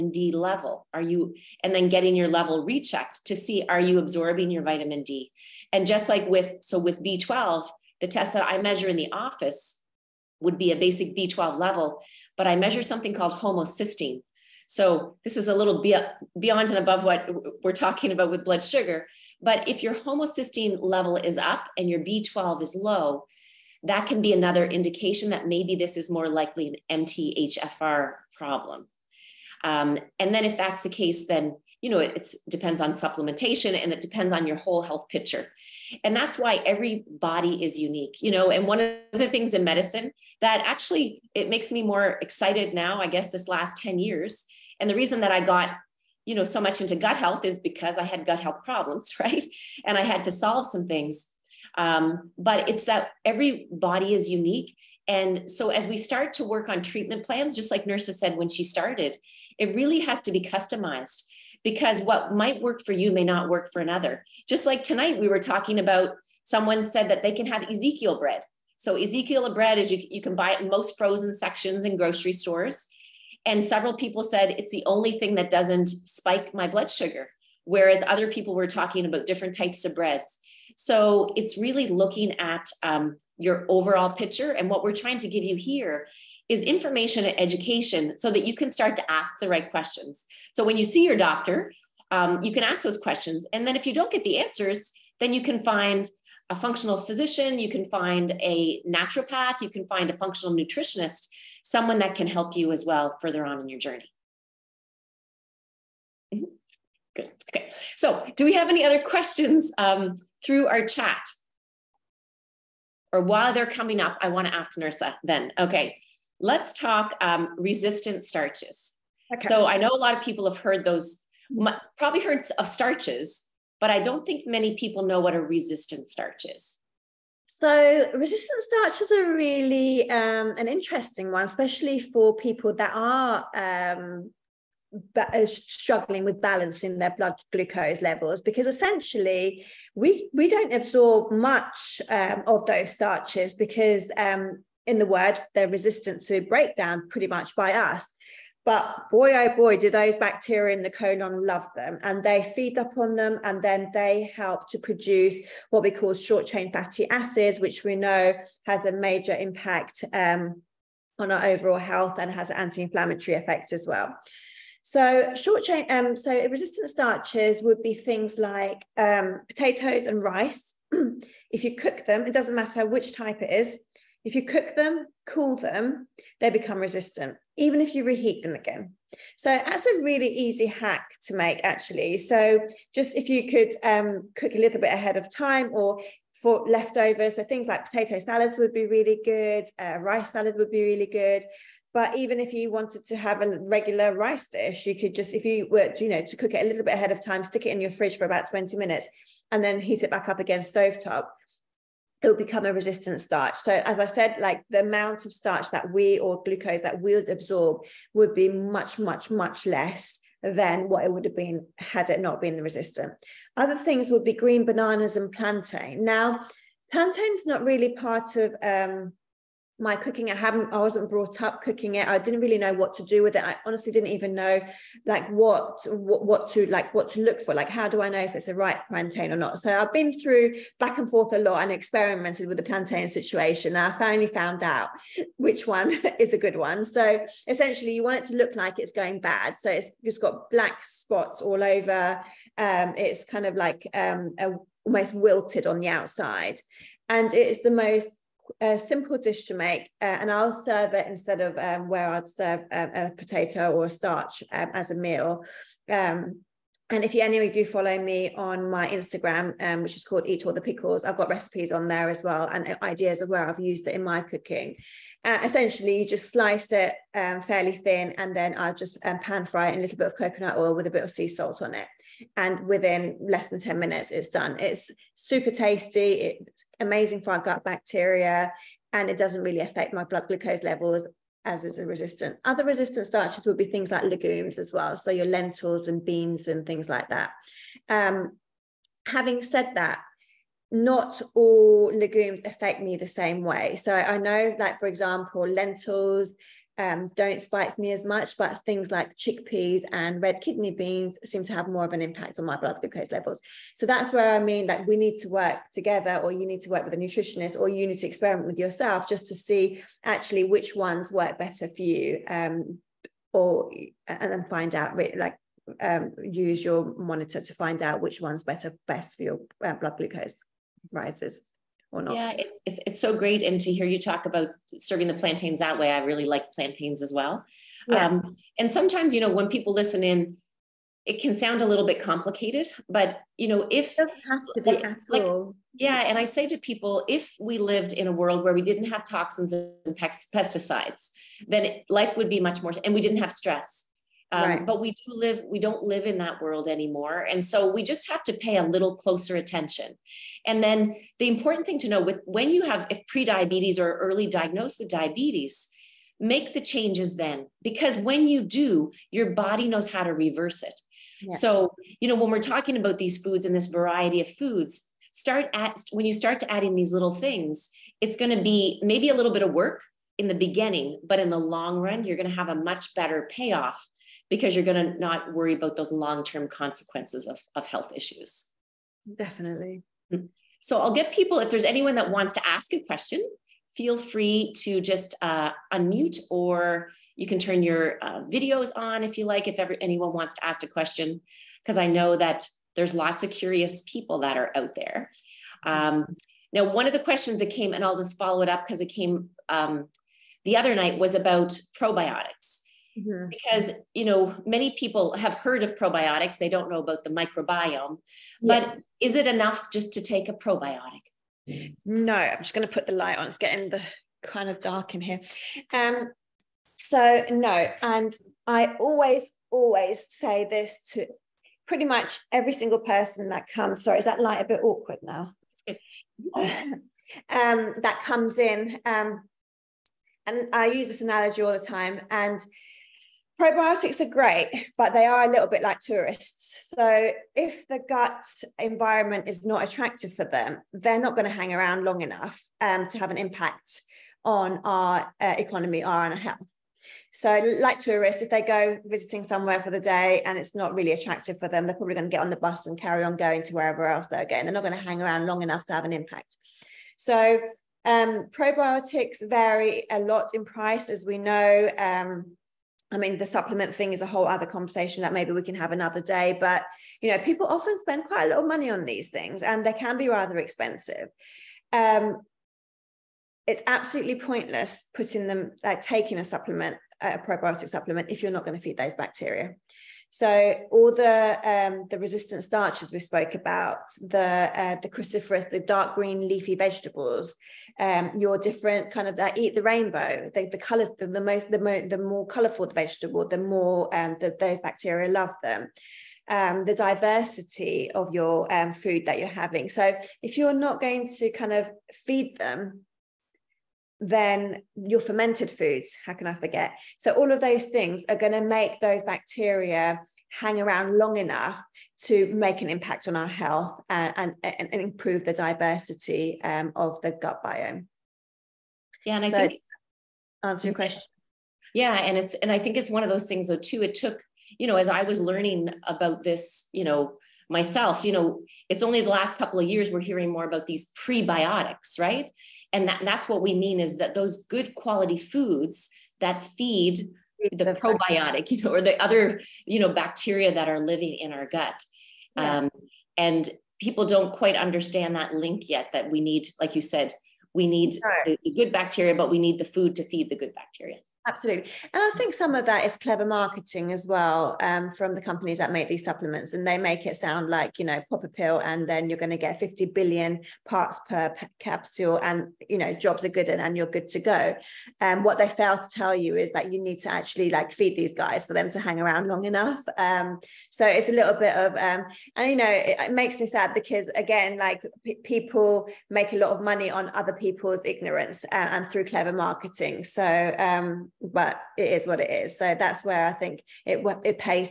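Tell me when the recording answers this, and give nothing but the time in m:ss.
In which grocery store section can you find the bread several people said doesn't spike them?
1:10.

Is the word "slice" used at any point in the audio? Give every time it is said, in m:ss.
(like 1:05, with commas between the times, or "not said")
4:26.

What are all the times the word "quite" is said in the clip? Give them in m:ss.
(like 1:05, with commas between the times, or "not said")
7:48, 9:04.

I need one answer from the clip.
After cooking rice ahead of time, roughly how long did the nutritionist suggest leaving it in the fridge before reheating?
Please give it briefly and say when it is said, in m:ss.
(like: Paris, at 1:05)
20 minutes, at 3:18.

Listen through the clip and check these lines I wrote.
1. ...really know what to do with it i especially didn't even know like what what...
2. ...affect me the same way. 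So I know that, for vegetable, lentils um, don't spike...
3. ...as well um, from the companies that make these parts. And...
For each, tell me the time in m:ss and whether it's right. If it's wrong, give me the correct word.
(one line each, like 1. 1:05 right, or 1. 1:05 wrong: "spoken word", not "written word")
1. 3:42 wrong: "honestly", not "especially"
2. 4:52 wrong: "example", not "vegetable"
3. 9:13 wrong: "supplements", not "parts".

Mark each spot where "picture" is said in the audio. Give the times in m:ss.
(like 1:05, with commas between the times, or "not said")
0:35, 1:24.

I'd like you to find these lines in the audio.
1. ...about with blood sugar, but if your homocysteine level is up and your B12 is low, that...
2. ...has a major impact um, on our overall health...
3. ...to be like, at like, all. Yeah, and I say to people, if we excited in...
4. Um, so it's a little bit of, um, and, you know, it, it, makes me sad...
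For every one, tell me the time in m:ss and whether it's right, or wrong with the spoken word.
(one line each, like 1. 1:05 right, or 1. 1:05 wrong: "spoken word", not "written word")
1. 0:18 right
2. 2:38 right
3. 5:34 wrong: "lived", not "excited"
4. 9:29 right.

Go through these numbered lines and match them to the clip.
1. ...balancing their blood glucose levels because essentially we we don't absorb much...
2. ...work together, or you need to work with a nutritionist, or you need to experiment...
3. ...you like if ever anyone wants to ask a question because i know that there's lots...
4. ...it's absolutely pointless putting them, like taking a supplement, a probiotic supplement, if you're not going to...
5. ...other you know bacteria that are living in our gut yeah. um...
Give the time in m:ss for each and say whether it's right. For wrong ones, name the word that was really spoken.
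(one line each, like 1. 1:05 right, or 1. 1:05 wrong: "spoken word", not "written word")
1. 2:16 right
2. 5:05 right
3. 6:29 right
4. 7:53 right
5. 8:59 right.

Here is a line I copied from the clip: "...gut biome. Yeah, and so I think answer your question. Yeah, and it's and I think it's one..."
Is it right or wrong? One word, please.
right.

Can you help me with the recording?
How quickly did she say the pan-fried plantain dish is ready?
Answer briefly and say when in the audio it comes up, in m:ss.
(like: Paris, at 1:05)
less than 10 minutes, at 4:33.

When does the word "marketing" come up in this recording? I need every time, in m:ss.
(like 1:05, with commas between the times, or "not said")
9:13, 9:39.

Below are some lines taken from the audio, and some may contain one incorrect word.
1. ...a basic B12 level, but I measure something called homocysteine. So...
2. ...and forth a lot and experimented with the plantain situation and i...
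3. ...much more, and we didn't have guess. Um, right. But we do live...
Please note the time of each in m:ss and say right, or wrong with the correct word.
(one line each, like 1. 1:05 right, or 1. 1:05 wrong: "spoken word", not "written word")
1. 0:10 right
2. 3:50 right
3. 5:42 wrong: "stress", not "guess".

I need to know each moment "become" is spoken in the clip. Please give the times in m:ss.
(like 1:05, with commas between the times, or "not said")
2:56, 3:22.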